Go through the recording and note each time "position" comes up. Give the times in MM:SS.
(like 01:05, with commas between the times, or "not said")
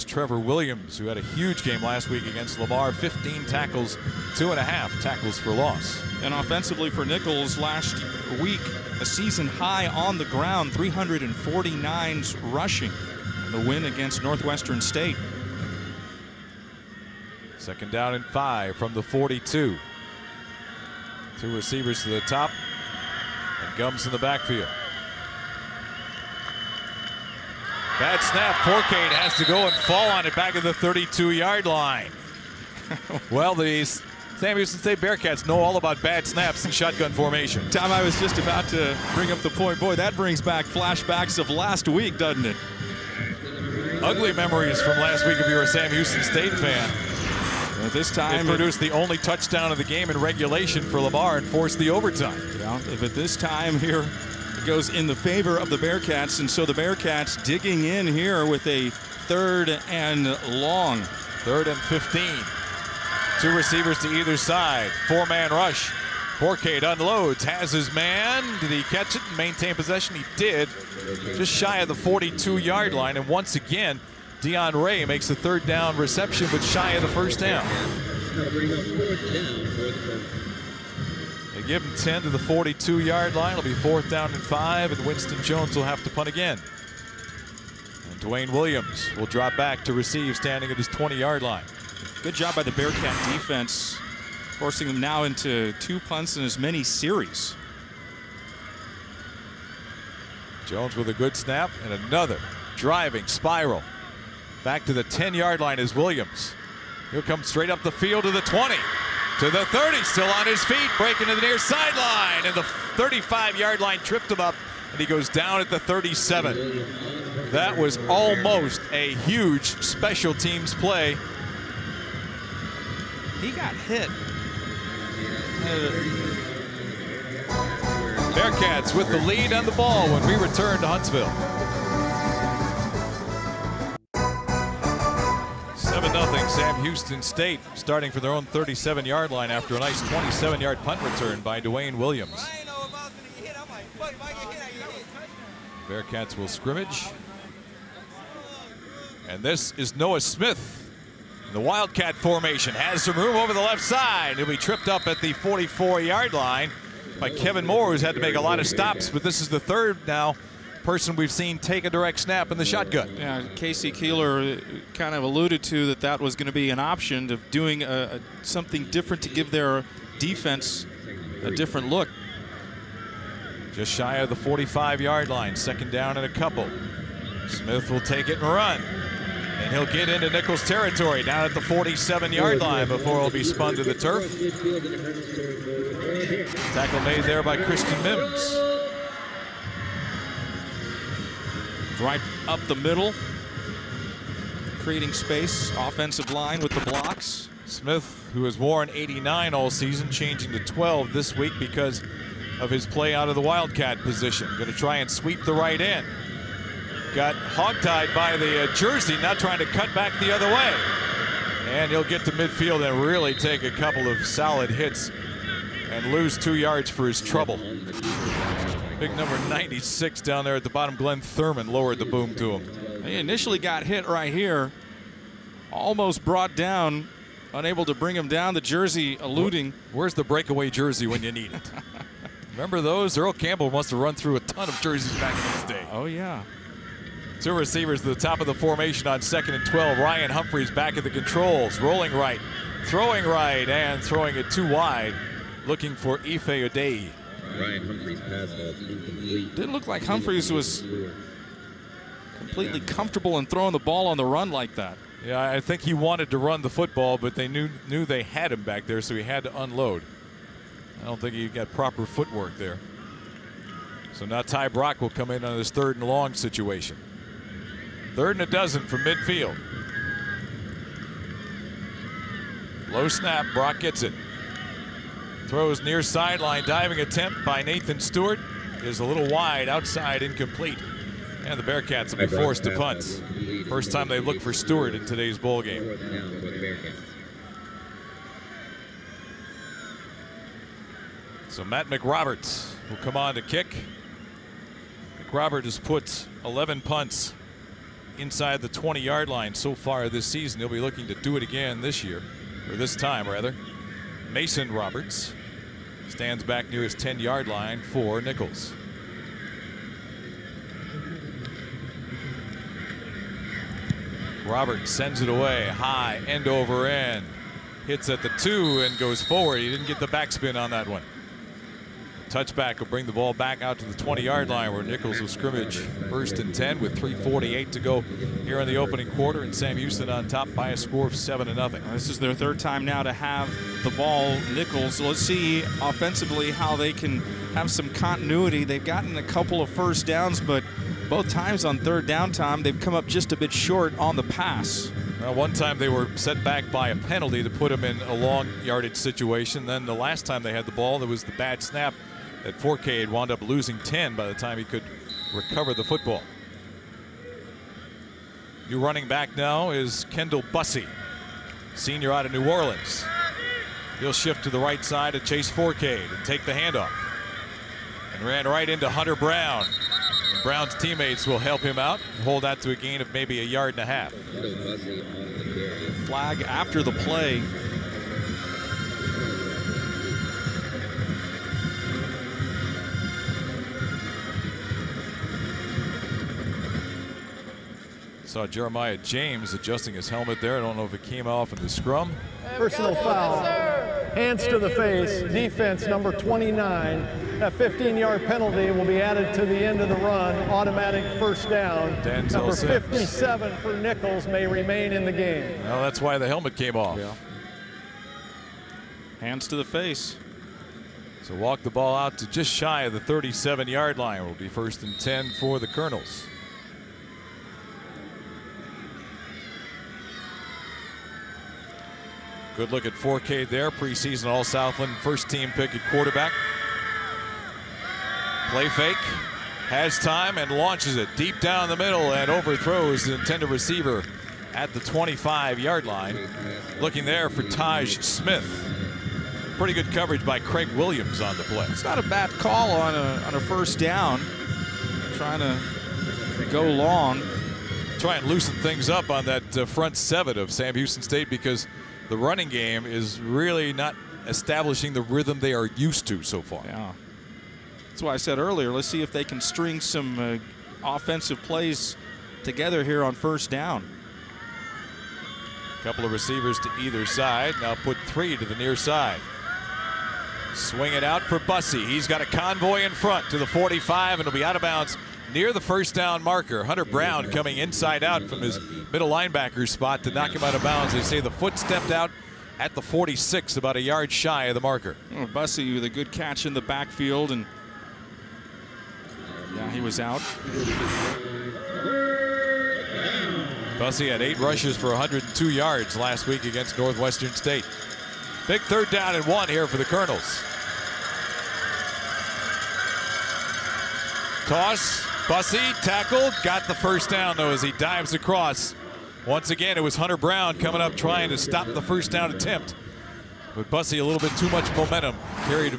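03:23.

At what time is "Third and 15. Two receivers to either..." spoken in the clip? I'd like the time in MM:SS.
01:01.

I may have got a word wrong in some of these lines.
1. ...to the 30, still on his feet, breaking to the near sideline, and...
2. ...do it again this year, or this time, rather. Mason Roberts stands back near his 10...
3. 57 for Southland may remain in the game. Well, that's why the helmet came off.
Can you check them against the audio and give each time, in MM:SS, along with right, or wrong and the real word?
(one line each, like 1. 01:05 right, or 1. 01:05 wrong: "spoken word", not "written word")
1. 01:49 right
2. 05:01 right
3. 06:42 wrong: "Nicholls", not "Southland".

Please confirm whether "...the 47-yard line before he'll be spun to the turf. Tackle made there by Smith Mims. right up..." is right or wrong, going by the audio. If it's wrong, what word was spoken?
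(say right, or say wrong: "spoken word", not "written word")
wrong: "Christian", not "Smith".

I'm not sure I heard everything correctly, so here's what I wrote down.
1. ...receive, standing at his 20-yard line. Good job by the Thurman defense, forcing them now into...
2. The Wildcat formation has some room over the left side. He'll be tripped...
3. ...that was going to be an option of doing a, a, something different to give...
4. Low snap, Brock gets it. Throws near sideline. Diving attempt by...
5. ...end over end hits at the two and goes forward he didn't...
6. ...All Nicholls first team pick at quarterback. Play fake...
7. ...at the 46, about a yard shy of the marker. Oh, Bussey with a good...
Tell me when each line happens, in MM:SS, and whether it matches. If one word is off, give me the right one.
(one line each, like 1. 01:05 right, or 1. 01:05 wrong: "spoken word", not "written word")
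1. 01:29 wrong: "Bearcat", not "Thurman"
2. 02:31 right
3. 02:45 right
4. 04:32 right
5. 05:16 right
6. 07:04 wrong: "Southland", not "Nicholls"
7. 08:02 right.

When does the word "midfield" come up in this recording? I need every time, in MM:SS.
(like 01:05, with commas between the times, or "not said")
03:32, 04:29.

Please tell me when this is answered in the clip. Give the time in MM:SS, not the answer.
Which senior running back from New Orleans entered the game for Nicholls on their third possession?
06:00.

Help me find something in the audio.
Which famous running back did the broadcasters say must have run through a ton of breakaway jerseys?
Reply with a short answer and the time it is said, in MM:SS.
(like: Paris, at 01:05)
Earl Campbell, at 03:53.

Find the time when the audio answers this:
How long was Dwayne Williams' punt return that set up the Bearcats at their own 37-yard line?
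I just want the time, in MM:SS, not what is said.
02:20.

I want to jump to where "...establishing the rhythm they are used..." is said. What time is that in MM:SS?
07:34.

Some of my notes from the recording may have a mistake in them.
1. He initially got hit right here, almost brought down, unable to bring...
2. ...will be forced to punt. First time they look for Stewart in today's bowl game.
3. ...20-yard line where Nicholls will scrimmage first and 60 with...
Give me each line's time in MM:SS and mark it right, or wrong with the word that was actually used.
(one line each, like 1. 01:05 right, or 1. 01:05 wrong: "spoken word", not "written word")
1. 03:43 right
2. 04:42 right
3. 05:23 wrong: "10", not "60".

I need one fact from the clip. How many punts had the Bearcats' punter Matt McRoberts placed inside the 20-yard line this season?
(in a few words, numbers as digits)
11.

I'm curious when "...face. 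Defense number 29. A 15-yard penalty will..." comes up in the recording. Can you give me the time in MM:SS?
06:34.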